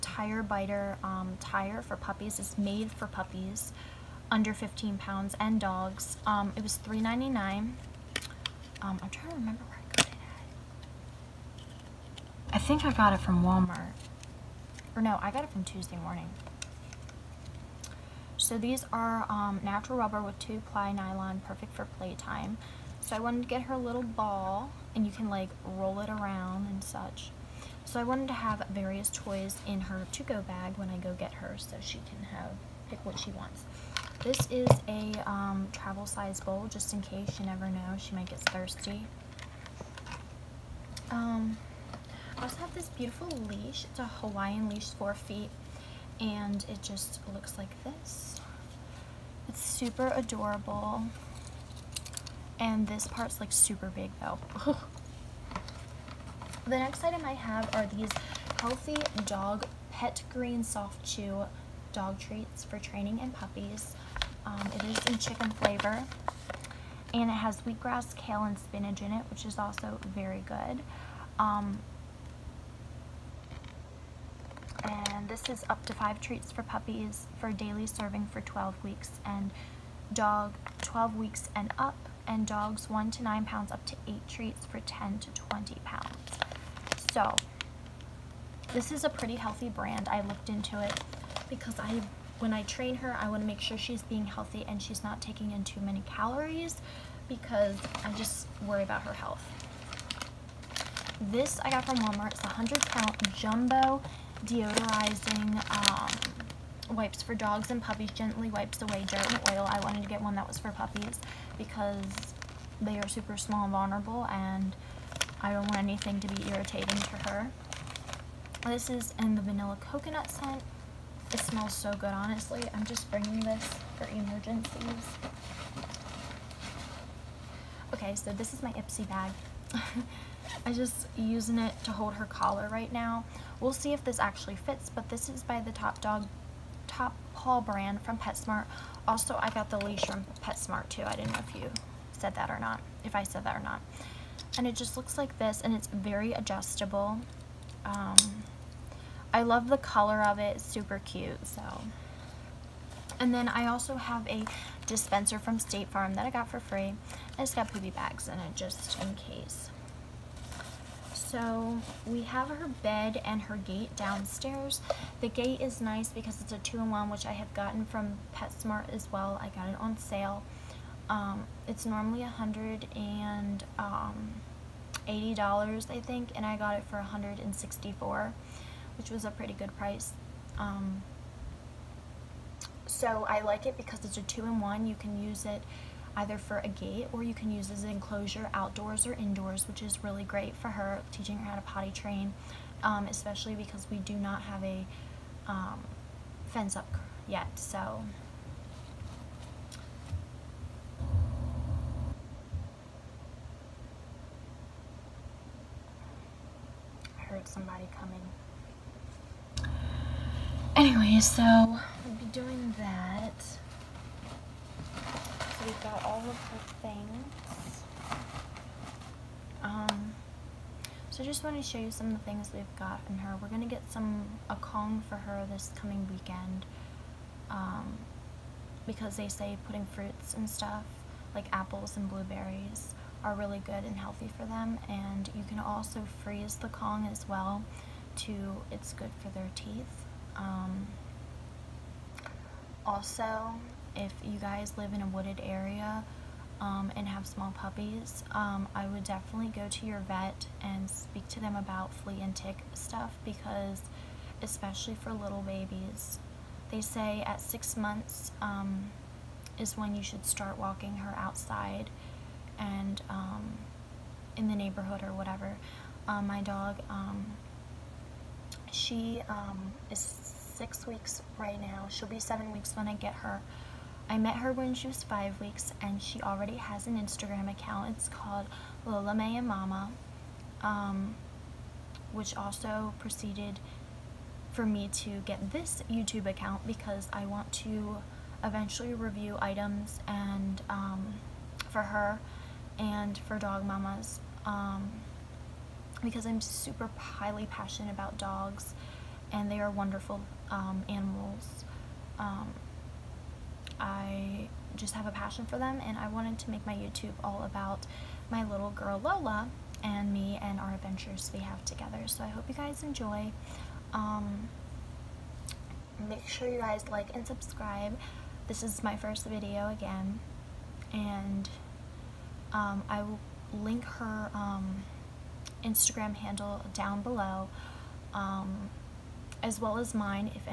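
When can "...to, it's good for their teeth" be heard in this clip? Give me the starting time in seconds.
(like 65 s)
238 s.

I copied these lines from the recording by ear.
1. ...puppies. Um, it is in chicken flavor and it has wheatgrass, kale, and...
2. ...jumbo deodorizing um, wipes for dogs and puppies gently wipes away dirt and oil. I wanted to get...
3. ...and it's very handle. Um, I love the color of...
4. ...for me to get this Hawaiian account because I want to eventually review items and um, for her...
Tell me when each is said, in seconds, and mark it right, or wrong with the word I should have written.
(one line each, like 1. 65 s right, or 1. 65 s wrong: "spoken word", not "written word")
1. 63 s right
2. 103 s right
3. 145 s wrong: "adjustable", not "handle"
4. 284 s wrong: "YouTube", not "Hawaiian".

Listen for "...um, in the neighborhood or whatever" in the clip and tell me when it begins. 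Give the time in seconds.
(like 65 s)
263 s.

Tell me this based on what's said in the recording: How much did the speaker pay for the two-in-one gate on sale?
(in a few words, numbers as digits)
164.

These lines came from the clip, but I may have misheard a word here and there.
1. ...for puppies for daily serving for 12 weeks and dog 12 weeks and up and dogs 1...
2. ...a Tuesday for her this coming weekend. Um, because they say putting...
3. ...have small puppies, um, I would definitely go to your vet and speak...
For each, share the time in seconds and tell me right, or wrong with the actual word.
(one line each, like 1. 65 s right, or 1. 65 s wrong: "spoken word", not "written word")
1. 76 s right
2. 224 s wrong: "Kong", not "Tuesday"
3. 247 s right.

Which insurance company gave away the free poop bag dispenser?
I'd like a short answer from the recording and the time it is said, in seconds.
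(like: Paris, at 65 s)
State Farm, at 155 s.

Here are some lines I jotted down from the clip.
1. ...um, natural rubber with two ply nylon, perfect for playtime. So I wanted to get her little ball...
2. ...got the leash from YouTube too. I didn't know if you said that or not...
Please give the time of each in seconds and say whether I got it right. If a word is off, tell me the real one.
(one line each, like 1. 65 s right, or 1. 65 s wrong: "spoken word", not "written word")
1. 19 s right
2. 139 s wrong: "PetSmart", not "YouTube".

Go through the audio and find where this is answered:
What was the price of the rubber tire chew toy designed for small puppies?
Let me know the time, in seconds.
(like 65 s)
6 s.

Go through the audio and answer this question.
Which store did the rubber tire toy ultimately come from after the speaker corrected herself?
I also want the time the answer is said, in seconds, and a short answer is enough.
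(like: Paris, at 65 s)
Tuesday Morning, at 15 s.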